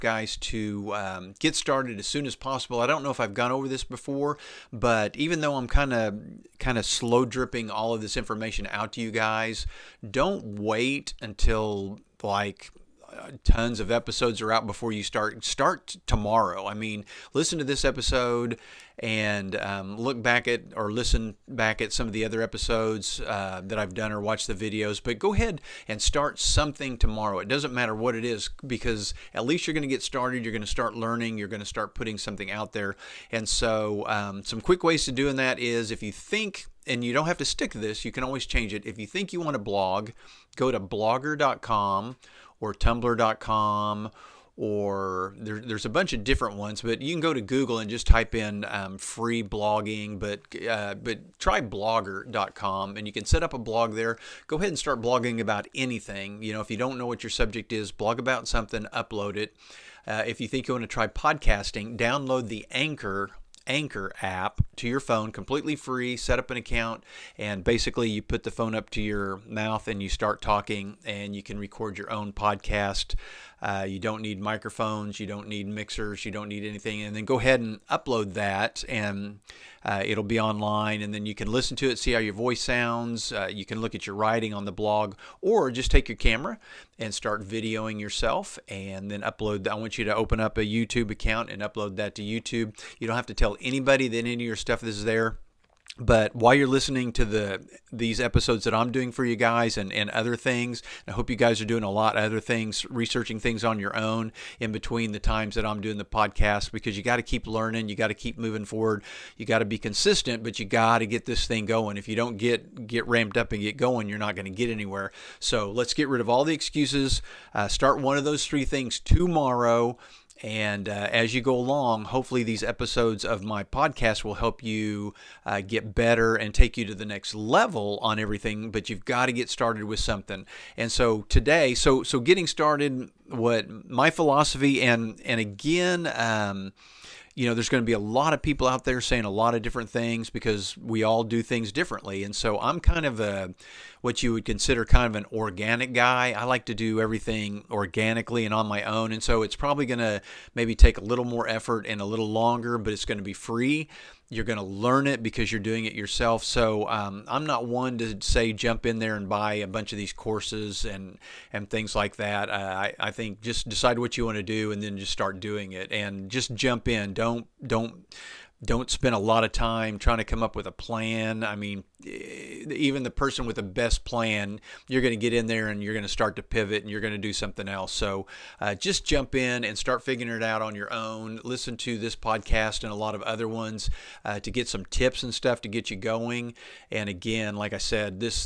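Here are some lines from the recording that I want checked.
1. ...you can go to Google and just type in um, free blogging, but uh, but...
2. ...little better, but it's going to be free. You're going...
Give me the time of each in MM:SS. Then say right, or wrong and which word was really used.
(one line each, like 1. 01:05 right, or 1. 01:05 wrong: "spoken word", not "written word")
1. 00:46 right
2. 02:32 wrong: "longer", not "better".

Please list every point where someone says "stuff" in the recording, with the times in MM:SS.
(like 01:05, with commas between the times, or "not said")
01:34, 03:05.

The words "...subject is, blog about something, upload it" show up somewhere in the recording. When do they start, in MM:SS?
00:57.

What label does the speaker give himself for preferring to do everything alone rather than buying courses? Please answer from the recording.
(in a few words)
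an organic guy.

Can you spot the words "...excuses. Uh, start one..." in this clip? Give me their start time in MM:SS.
01:56.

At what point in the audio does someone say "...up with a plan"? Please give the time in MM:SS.
02:50.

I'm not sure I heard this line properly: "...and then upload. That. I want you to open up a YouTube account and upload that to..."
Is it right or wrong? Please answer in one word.
right.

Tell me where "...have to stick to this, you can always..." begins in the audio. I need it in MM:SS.
00:37.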